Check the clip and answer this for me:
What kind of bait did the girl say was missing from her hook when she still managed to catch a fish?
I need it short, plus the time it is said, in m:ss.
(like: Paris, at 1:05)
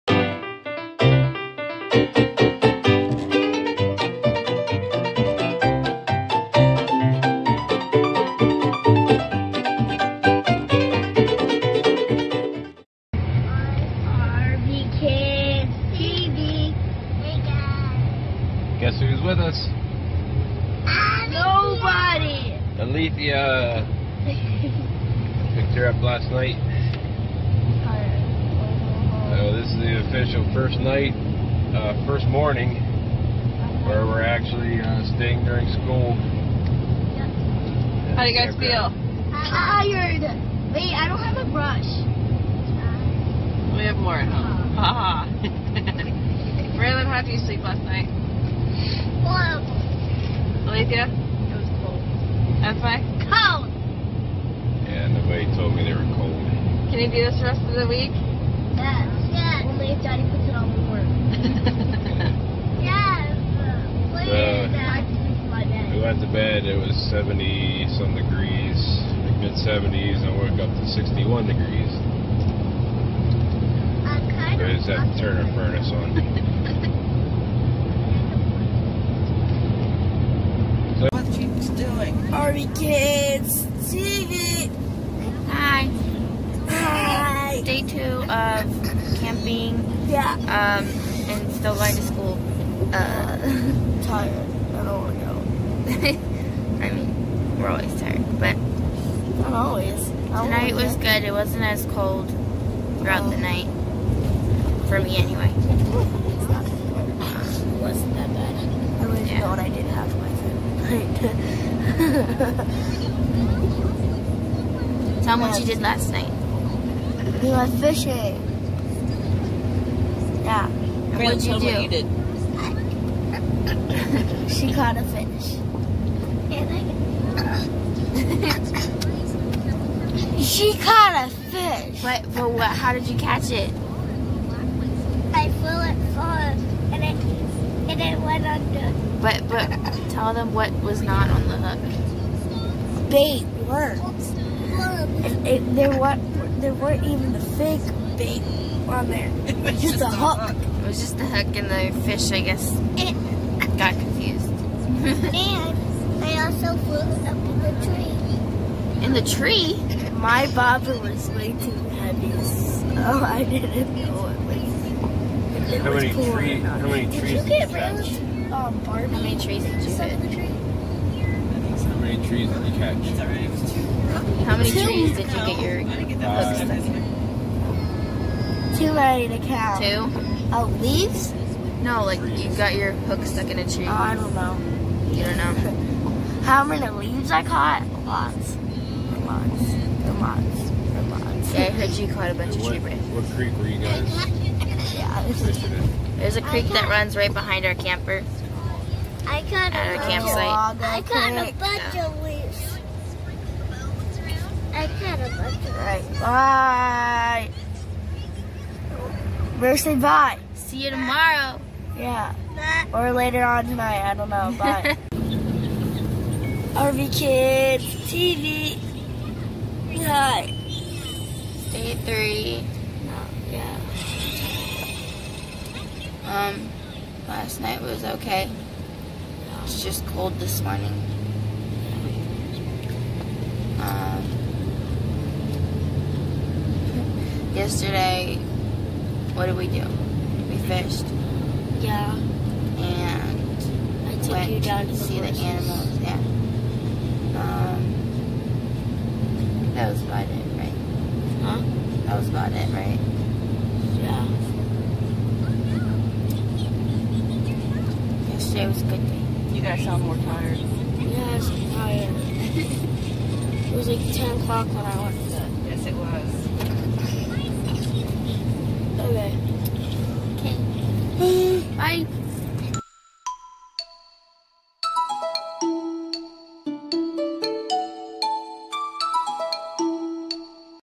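Bait worms, at 2:23.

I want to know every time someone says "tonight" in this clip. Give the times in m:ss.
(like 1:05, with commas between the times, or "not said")
1:40, 3:33.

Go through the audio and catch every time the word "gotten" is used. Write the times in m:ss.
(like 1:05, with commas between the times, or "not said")
not said.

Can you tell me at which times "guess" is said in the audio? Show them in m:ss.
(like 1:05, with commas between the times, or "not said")
0:18, 2:32.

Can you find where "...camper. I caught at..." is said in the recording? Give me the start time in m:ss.
3:17.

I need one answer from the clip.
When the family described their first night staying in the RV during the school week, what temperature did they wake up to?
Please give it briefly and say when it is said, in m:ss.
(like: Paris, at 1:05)
61 degrees, at 1:10.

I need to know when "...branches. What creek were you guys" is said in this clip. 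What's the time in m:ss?
3:12.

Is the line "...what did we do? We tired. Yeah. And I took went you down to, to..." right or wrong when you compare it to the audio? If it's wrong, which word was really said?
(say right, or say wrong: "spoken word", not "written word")
wrong: "fished", not "tired".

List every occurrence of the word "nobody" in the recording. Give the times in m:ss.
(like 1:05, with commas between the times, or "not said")
0:21, 0:55.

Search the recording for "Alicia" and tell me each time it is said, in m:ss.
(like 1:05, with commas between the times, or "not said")
0:50.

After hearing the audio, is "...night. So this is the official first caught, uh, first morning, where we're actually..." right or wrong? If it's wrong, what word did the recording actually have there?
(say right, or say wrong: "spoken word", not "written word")
wrong: "night", not "caught".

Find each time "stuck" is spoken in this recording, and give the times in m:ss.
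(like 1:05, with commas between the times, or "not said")
2:56, 3:03.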